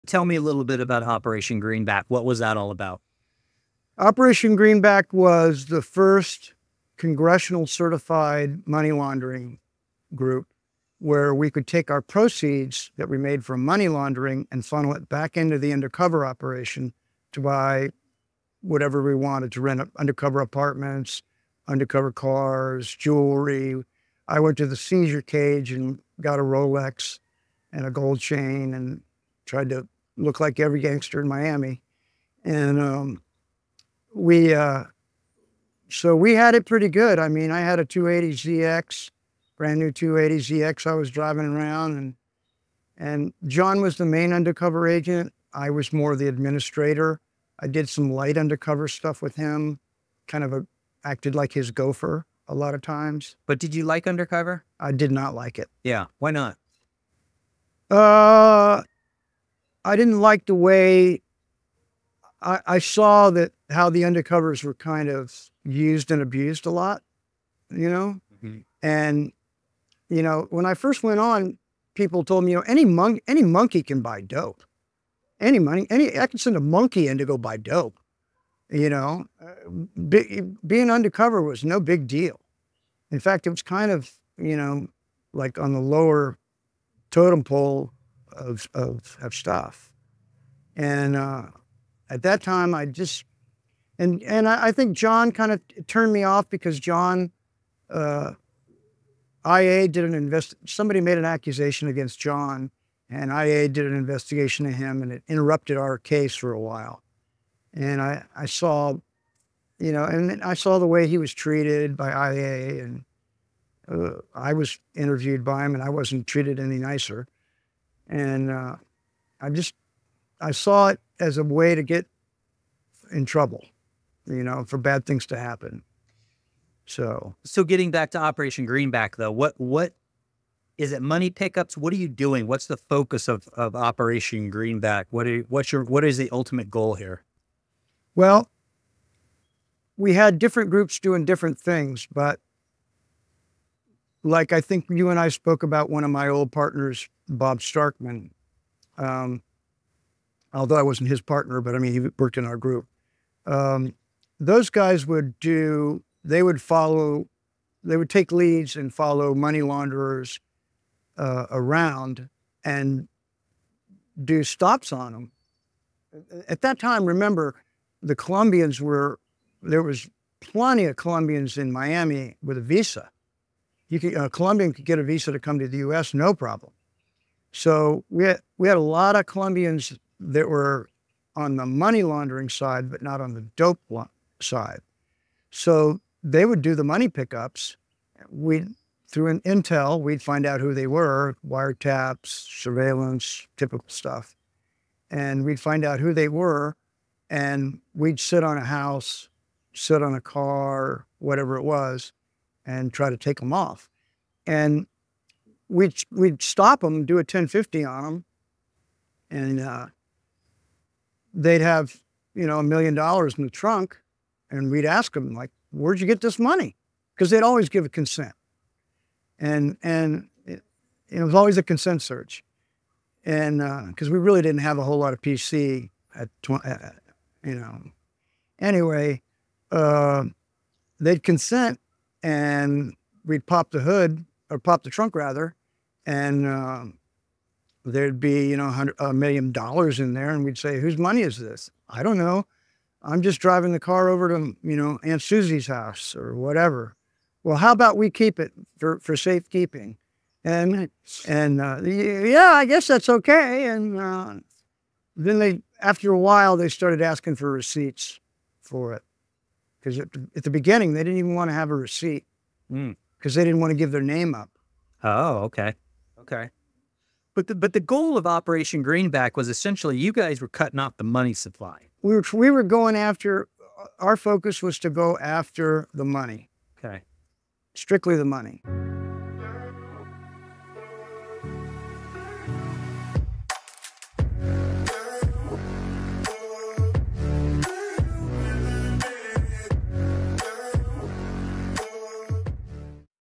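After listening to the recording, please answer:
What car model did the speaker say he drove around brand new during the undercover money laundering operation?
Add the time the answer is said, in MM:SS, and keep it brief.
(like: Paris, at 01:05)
280ZX, at 00:39.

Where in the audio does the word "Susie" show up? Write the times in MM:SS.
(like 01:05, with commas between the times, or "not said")
04:05.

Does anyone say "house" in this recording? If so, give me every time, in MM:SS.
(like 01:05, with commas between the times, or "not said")
03:18, 04:05.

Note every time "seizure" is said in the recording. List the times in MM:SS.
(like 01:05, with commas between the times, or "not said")
00:24.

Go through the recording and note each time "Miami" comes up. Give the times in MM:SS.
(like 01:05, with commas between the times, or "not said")
00:31, 02:51.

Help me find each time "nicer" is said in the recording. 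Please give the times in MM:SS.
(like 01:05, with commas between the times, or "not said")
01:56.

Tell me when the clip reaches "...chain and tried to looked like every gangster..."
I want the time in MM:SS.
00:28.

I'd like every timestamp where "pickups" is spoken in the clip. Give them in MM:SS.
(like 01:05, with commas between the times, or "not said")
02:11, 03:07.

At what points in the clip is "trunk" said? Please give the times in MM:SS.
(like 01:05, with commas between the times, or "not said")
03:33, 03:54.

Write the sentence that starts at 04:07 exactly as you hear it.
Well, how about we keep it for for safekeeping?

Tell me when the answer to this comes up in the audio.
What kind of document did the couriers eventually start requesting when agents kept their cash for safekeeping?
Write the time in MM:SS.
04:17.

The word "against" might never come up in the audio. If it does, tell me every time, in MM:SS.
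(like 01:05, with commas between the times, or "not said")
01:41.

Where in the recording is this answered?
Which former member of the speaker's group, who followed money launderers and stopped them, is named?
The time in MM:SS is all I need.
02:27.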